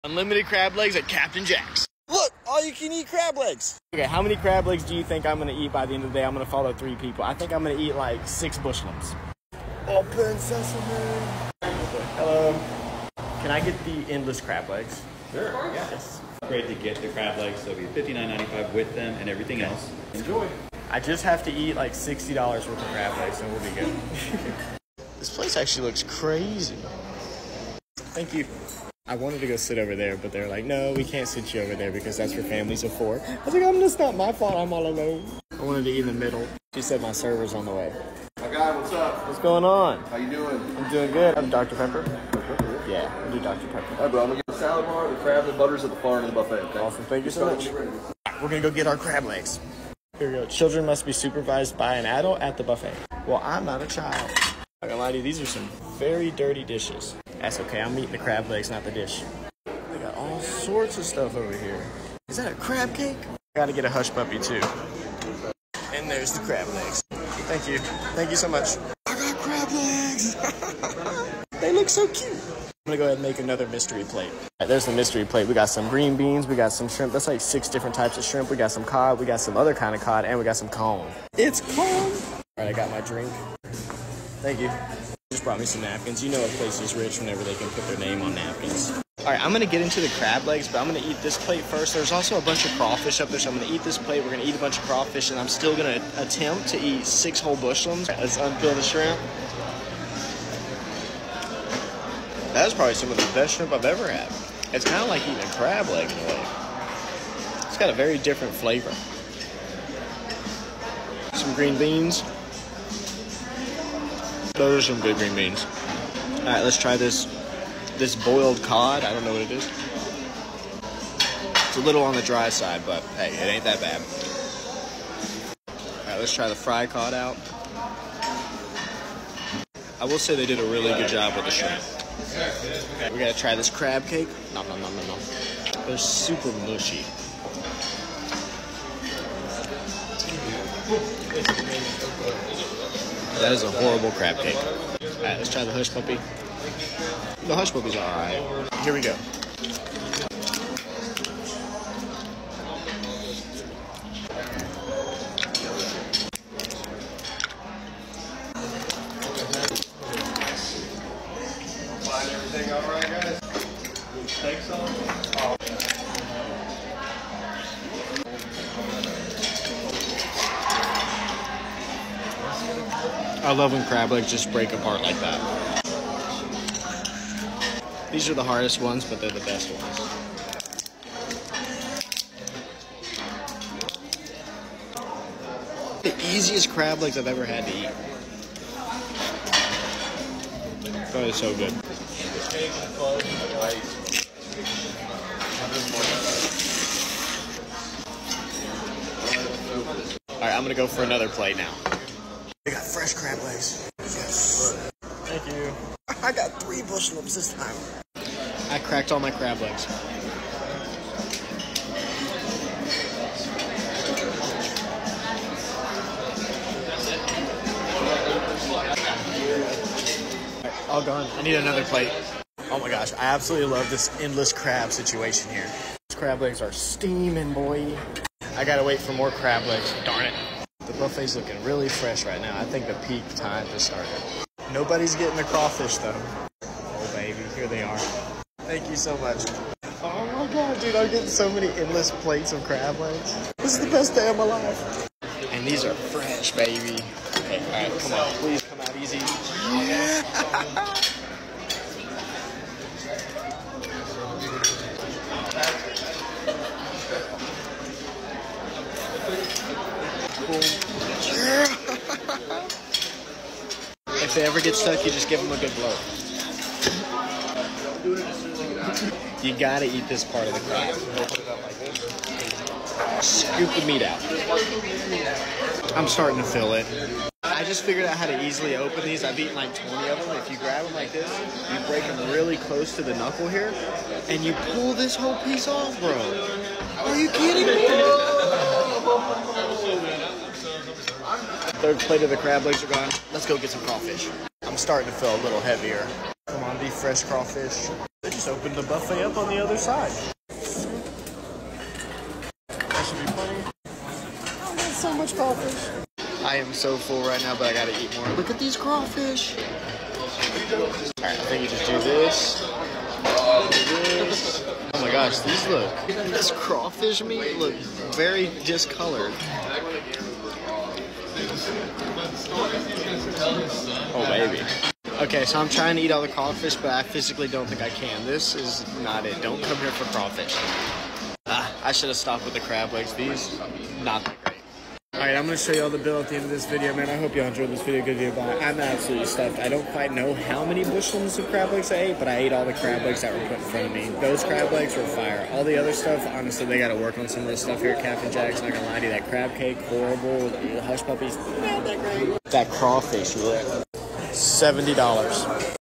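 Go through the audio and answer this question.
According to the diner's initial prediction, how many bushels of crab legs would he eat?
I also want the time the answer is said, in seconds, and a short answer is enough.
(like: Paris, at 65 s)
6, at 8 s.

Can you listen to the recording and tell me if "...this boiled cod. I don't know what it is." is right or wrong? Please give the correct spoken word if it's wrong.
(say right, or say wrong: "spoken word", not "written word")
right.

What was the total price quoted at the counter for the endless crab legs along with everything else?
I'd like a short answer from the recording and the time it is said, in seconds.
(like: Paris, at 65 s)
$59.95, at 18 s.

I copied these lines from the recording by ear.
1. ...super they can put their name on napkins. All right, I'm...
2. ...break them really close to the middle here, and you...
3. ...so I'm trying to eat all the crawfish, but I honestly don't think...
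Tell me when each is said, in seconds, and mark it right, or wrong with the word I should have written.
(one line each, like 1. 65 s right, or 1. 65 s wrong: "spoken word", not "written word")
1. 87 s wrong: "whenever", not "super"
2. 281 s wrong: "knuckle", not "middle"
3. 325 s wrong: "physically", not "honestly".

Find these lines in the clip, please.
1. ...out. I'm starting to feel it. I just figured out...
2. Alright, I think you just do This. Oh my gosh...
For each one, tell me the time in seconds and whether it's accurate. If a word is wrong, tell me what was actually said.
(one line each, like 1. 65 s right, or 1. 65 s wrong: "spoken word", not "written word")
1. 274 s right
2. 310 s right.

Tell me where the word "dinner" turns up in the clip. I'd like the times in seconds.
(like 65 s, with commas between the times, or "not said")
not said.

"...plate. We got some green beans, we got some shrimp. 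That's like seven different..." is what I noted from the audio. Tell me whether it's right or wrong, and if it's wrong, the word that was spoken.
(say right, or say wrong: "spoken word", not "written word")
wrong: "six", not "seven".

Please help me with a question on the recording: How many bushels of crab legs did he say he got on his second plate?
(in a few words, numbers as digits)
3.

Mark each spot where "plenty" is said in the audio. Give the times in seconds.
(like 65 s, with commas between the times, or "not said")
303 s.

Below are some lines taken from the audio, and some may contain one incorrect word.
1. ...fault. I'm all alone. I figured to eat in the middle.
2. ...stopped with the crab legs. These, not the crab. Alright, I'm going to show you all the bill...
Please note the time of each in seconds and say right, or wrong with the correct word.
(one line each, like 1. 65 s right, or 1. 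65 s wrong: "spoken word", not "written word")
1. 34 s wrong: "wanted", not "figured"
2. 332 s right.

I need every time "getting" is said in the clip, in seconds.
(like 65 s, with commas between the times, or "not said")
235 s, 241 s.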